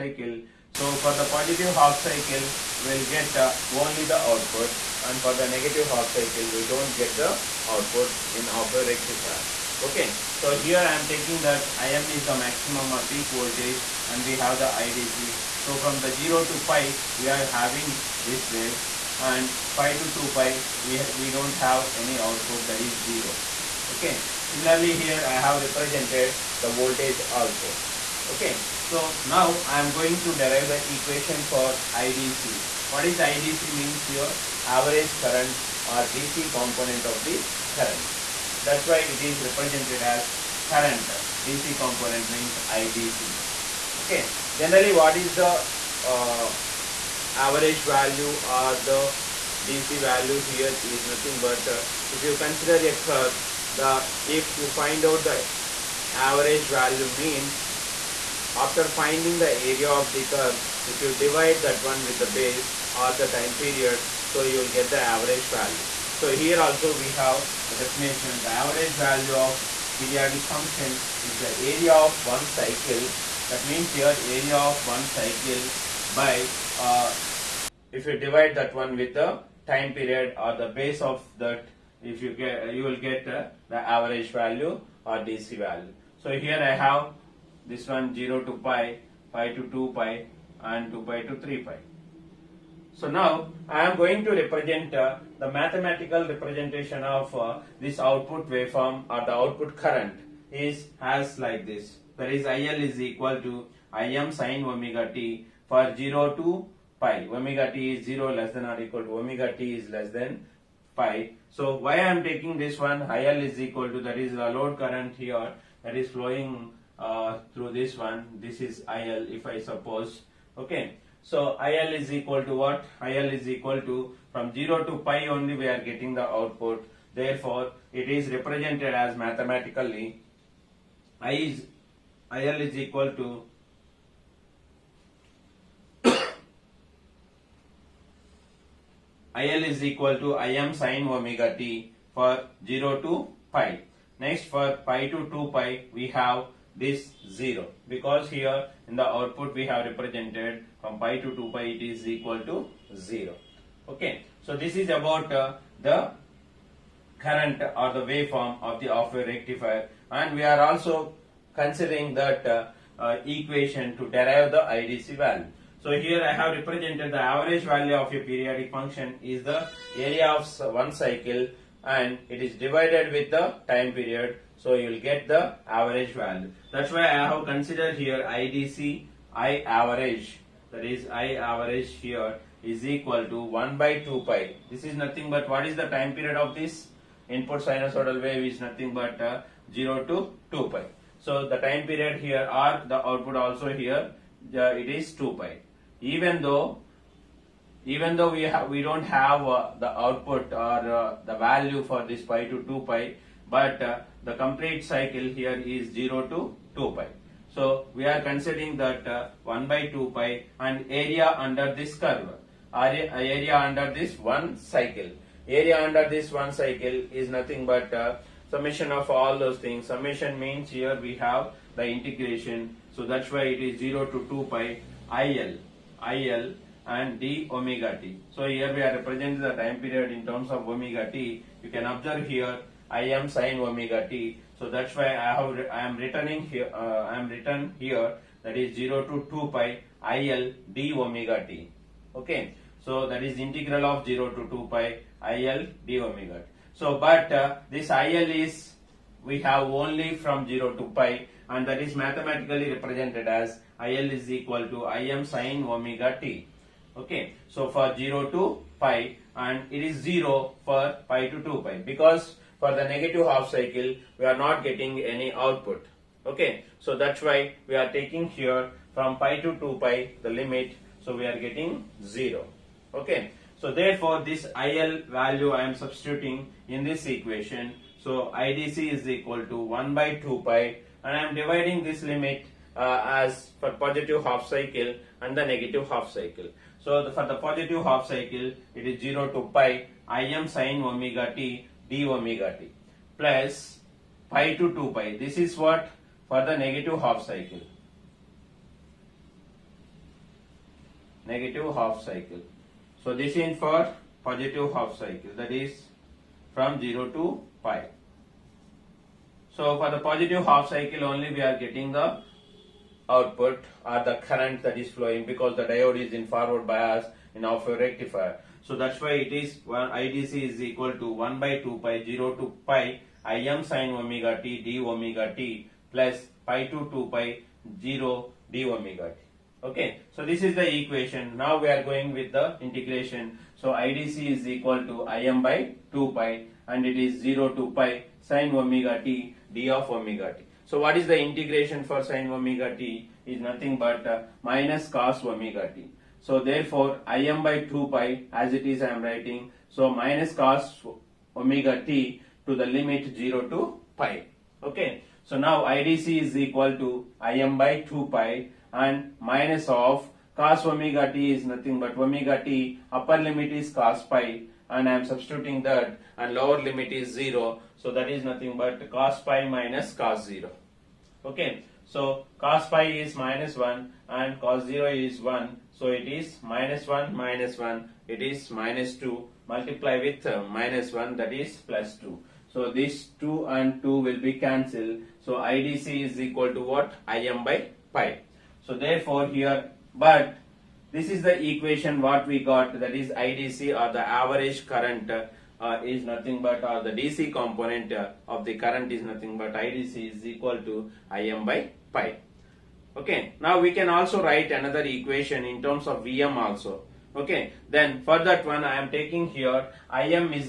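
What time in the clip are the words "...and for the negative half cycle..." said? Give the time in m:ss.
0:05.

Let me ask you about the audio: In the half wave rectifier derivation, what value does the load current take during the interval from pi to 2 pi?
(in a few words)
0.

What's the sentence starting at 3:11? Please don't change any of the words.
So the time period here or the output also here uh, it is 2 pi.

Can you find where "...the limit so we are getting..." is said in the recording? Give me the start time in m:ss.
4:30.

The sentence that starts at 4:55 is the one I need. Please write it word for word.
This is what for the negative half cycle.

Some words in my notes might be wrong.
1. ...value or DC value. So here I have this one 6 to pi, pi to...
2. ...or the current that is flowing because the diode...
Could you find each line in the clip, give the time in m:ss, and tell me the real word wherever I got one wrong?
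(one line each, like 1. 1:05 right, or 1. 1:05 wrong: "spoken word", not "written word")
1. 1:24 wrong: "0", not "6"
2. 5:13 right.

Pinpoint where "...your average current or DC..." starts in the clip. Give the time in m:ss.
0:34.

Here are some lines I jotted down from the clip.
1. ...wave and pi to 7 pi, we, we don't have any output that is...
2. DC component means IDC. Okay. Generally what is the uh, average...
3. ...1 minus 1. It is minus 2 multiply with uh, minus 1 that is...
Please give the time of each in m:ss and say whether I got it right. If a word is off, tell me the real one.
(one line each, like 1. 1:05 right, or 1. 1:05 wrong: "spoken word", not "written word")
1. 0:18 wrong: "2", not "7"
2. 0:41 right
3. 6:16 right.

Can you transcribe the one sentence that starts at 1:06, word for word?
So here also we have the definition, the average value of periodic function is the area of one cycle.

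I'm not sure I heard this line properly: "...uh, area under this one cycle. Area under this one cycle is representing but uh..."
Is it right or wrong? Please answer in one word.
wrong.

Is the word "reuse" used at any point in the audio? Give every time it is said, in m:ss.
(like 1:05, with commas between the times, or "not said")
not said.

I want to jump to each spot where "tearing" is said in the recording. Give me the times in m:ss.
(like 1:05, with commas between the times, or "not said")
not said.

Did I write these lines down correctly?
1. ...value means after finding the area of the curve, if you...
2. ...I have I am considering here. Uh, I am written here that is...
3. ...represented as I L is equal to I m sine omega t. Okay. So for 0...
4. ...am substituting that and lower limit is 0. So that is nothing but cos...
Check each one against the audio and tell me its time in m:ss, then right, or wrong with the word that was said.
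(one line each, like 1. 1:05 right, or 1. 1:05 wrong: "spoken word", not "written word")
1. 0:56 right
2. 3:55 wrong: "returning", not "considering"
3. 4:12 right
4. 6:04 right.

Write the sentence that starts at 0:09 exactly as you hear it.
Okay, so here I am taking that Im is the maximum or peak voltage and we have the IDC.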